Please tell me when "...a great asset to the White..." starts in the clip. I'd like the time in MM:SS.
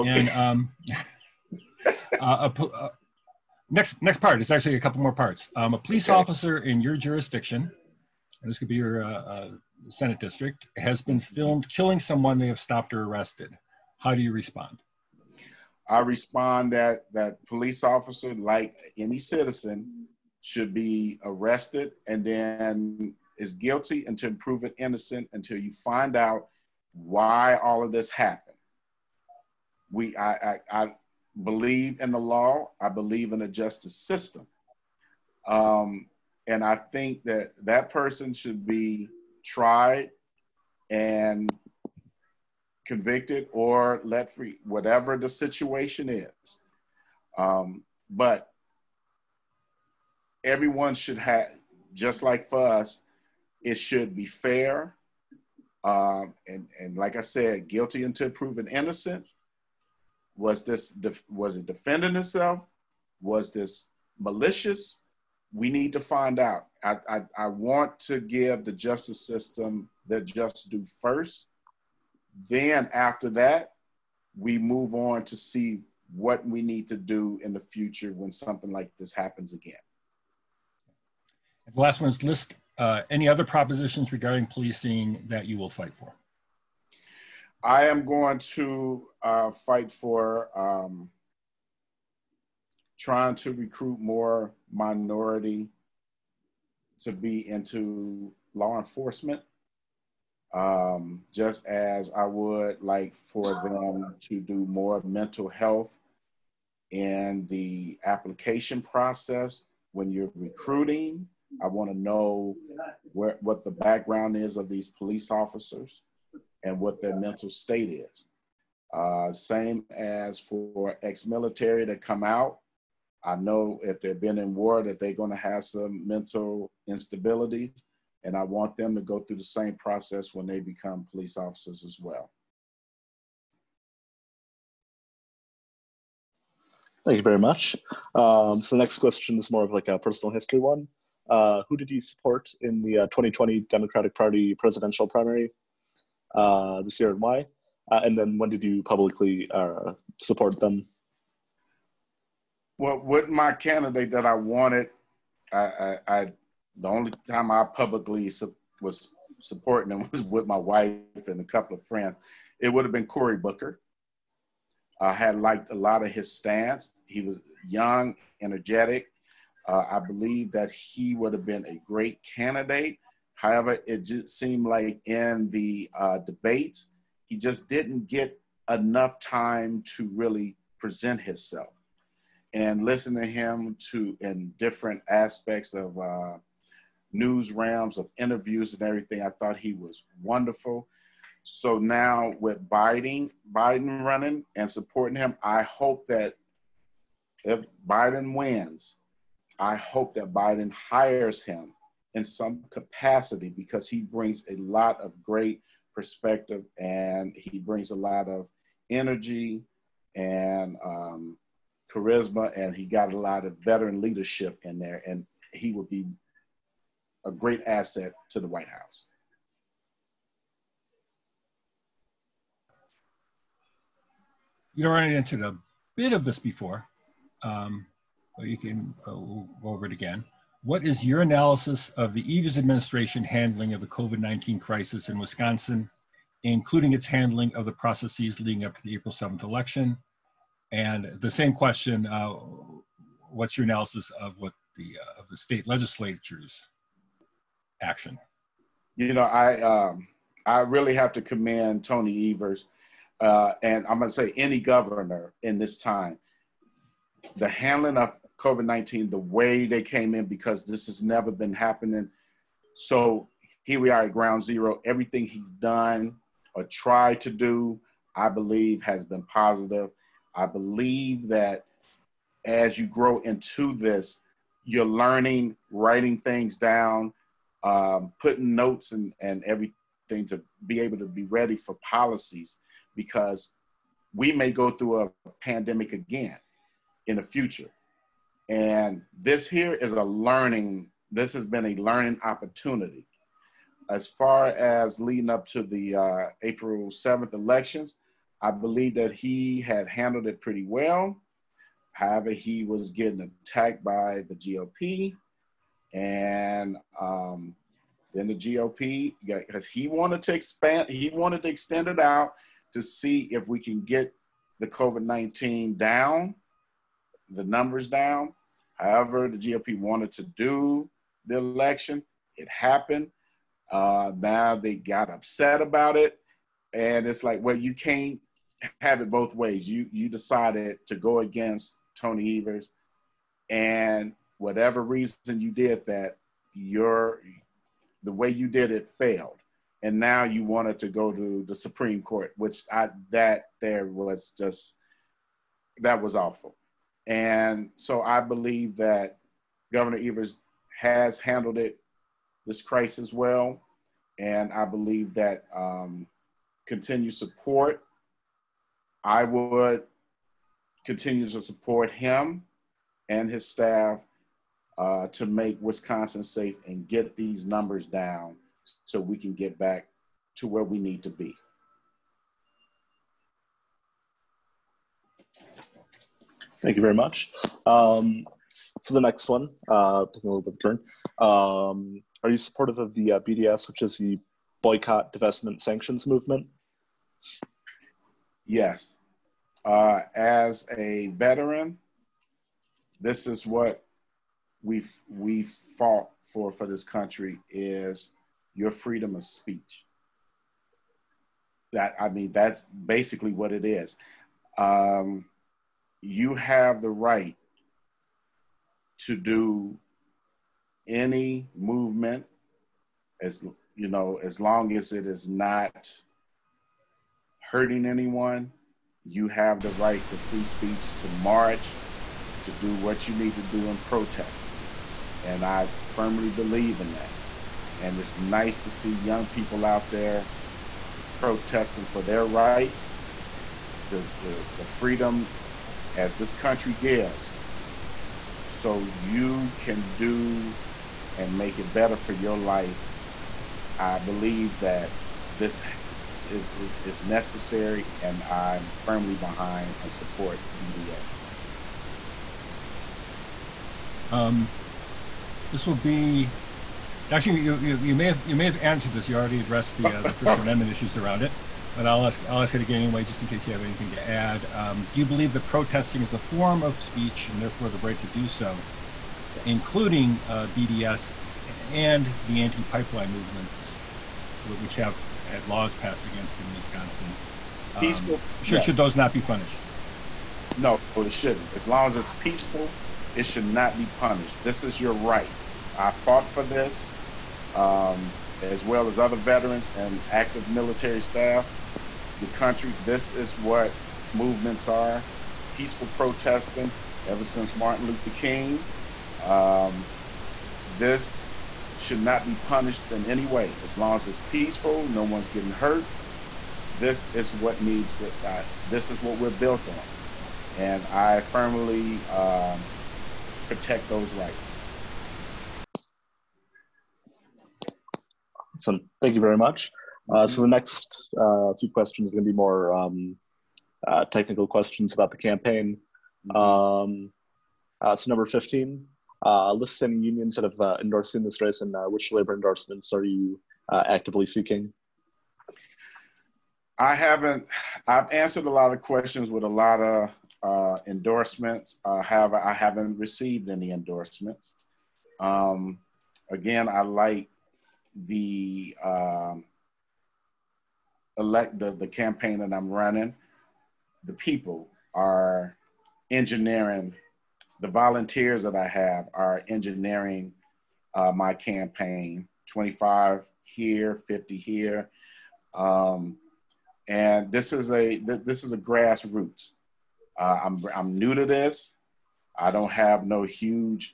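03:37.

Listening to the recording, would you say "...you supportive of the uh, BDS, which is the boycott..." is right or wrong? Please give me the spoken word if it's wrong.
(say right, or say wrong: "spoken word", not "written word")
right.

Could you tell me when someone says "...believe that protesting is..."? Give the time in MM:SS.
07:45.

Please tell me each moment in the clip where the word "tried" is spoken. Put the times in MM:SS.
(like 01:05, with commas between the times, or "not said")
00:39, 04:26.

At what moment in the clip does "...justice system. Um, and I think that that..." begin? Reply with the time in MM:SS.
00:33.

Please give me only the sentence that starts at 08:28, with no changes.
Uh, this is what we're built on, and I firmly um, protect those rights.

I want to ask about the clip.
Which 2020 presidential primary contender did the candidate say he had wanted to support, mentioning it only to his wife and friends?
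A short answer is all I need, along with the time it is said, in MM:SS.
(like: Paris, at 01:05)
Cory Booker, at 02:43.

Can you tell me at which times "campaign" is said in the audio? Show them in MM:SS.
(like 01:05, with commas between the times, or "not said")
08:45, 09:11, 09:21.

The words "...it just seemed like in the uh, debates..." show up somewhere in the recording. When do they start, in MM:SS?
02:53.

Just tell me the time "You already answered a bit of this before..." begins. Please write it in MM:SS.
03:44.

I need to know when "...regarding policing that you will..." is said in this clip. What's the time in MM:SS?
01:24.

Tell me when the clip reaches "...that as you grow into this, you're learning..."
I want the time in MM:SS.
04:31.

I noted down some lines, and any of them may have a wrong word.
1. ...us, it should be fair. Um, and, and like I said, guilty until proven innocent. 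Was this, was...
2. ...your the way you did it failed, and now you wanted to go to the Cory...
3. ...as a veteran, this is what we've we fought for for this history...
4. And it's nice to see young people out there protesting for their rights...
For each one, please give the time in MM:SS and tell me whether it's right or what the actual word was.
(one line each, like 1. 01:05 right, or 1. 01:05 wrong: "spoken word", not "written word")
1. 00:52 right
2. 05:36 wrong: "Supreme", not "Cory"
3. 06:30 wrong: "country", not "history"
4. 07:07 right.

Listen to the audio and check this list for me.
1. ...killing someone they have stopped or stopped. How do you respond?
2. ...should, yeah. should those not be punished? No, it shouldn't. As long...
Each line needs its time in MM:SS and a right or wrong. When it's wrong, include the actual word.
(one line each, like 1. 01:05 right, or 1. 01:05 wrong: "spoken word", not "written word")
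1. 00:11 wrong: "arrested", not "stopped"
2. 07:58 right.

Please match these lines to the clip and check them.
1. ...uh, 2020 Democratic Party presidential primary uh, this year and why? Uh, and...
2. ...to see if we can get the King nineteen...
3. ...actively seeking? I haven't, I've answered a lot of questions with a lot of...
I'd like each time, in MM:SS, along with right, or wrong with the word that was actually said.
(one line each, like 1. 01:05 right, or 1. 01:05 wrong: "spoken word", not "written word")
1. 02:22 right
2. 05:12 wrong: "COVID", not "King"
3. 08:53 right.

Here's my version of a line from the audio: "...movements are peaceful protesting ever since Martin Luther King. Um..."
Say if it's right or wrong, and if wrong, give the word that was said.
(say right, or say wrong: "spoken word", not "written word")
right.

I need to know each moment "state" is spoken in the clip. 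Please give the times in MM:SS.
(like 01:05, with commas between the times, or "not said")
01:57, 04:05.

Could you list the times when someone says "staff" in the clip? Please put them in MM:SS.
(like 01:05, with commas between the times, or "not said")
06:03, 08:10.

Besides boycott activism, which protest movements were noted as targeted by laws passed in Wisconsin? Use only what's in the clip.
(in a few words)
anti-pipeline movements.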